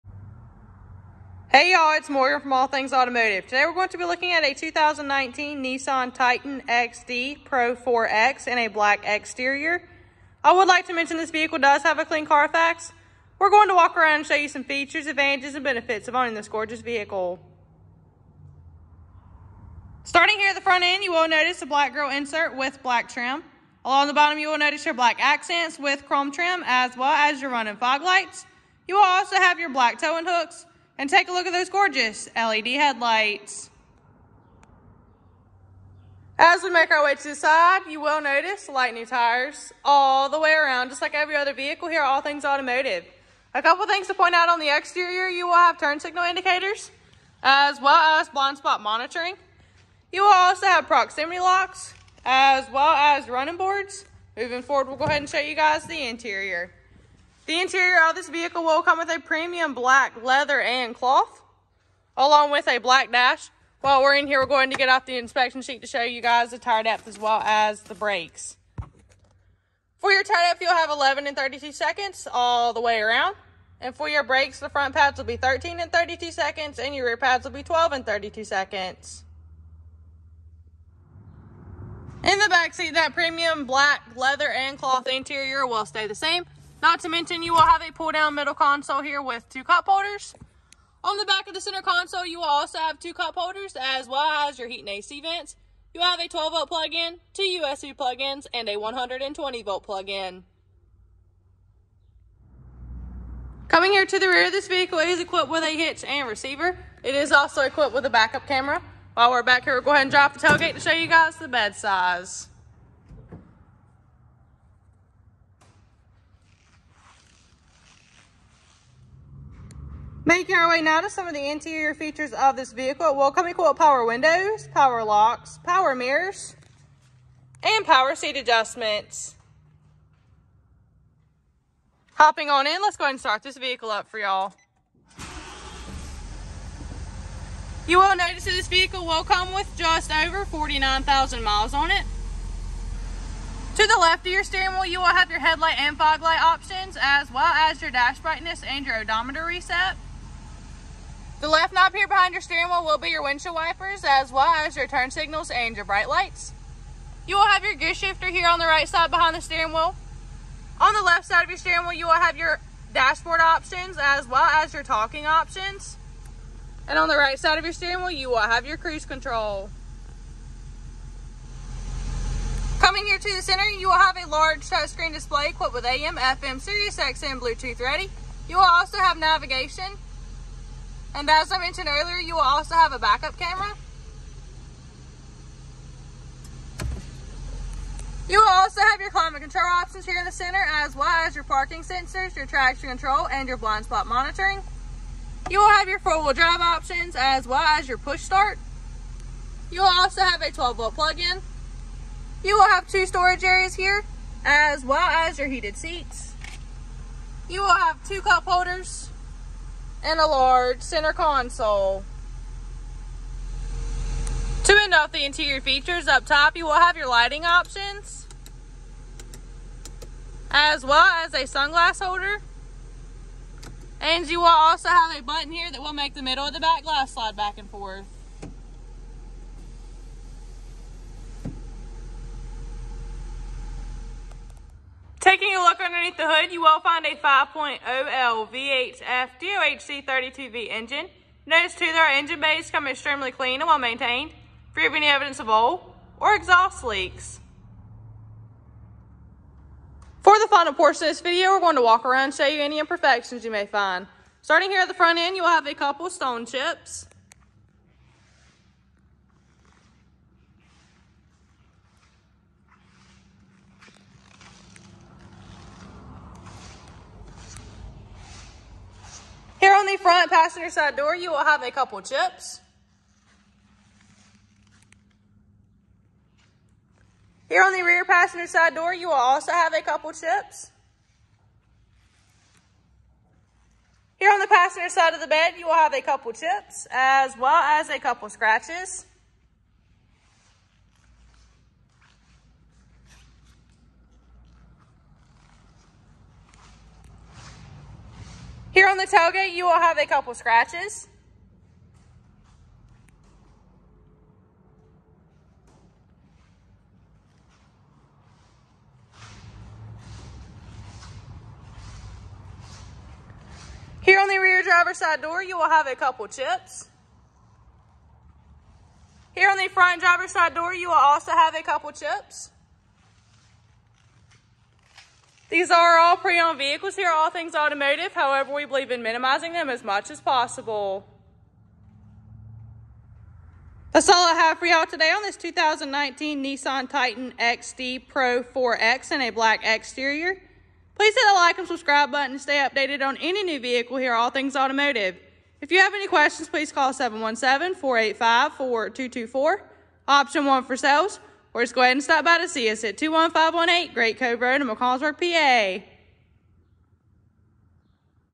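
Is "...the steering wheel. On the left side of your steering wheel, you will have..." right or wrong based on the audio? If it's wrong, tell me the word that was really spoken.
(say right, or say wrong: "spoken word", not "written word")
right.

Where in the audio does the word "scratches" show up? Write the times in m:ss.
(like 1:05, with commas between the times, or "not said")
4:48, 5:00.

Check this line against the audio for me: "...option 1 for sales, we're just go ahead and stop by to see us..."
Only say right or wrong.
right.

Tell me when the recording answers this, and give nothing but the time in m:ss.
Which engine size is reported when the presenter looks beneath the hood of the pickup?
3:57.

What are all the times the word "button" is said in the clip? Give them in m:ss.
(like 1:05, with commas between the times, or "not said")
3:45, 5:42.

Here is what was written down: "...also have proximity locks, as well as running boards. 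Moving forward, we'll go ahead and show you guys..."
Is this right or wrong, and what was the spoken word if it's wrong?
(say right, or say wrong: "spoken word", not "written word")
right.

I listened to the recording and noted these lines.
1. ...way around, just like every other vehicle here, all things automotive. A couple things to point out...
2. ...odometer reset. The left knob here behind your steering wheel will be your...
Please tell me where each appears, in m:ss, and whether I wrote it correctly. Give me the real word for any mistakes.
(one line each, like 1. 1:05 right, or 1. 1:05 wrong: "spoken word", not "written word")
1. 0:40 right
2. 2:28 right.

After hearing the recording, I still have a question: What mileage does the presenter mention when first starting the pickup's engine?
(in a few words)
just over 49,000 miles.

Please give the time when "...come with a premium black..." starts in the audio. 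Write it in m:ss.
0:58.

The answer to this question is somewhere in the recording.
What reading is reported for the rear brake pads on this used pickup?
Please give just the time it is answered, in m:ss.
1:17.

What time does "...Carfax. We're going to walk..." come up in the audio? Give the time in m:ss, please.
0:12.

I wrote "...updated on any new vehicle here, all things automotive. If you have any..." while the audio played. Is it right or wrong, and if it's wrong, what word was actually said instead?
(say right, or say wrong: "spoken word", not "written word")
right.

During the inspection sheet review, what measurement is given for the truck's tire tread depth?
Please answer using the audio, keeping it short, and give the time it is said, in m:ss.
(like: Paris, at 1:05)
11/32, at 1:10.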